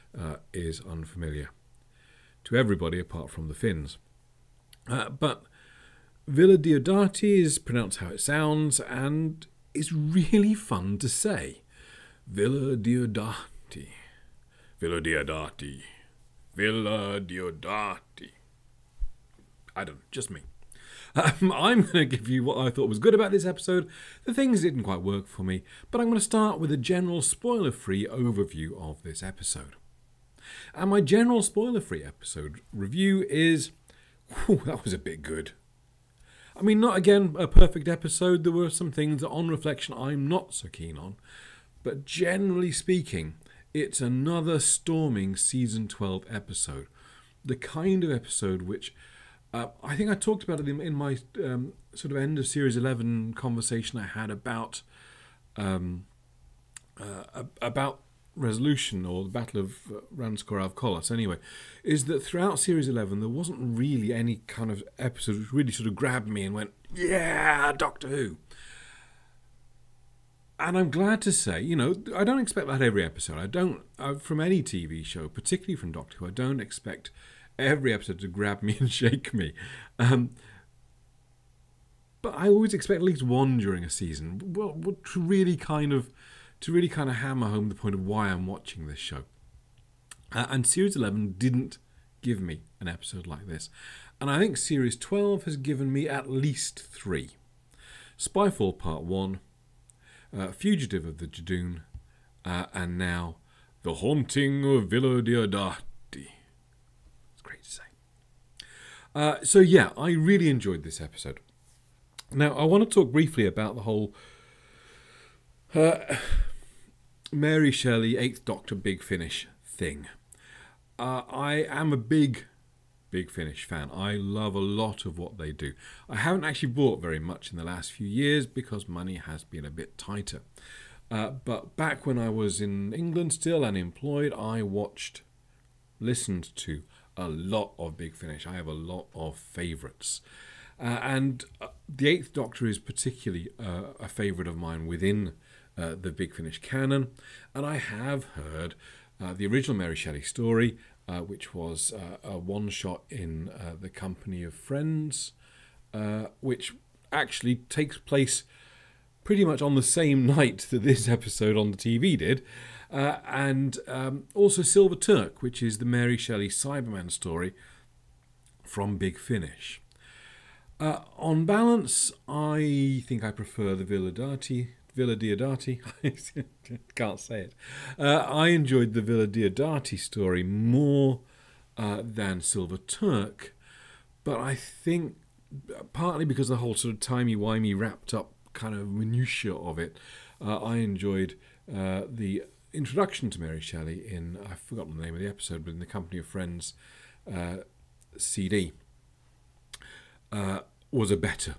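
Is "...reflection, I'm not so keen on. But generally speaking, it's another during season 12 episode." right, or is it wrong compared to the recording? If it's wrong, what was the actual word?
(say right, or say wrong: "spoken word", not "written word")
wrong: "storming", not "during".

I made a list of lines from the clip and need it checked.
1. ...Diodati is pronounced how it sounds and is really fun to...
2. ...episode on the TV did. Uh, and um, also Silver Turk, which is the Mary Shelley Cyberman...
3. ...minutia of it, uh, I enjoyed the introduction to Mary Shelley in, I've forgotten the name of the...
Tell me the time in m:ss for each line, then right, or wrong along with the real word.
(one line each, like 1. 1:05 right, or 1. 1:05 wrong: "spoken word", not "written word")
1. 0:06 right
2. 2:41 right
3. 3:08 right.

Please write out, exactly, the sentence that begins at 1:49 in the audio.
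Uh, so, yeah, I really enjoyed this episode.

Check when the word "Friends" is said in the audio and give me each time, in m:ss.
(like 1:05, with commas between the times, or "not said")
2:34, 3:16.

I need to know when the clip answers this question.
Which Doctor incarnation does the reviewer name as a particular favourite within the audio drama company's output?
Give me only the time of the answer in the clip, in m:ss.
2:21.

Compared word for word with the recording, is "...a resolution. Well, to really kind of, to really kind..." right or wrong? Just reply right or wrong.
wrong.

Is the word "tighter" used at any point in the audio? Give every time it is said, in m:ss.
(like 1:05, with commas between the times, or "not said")
2:09.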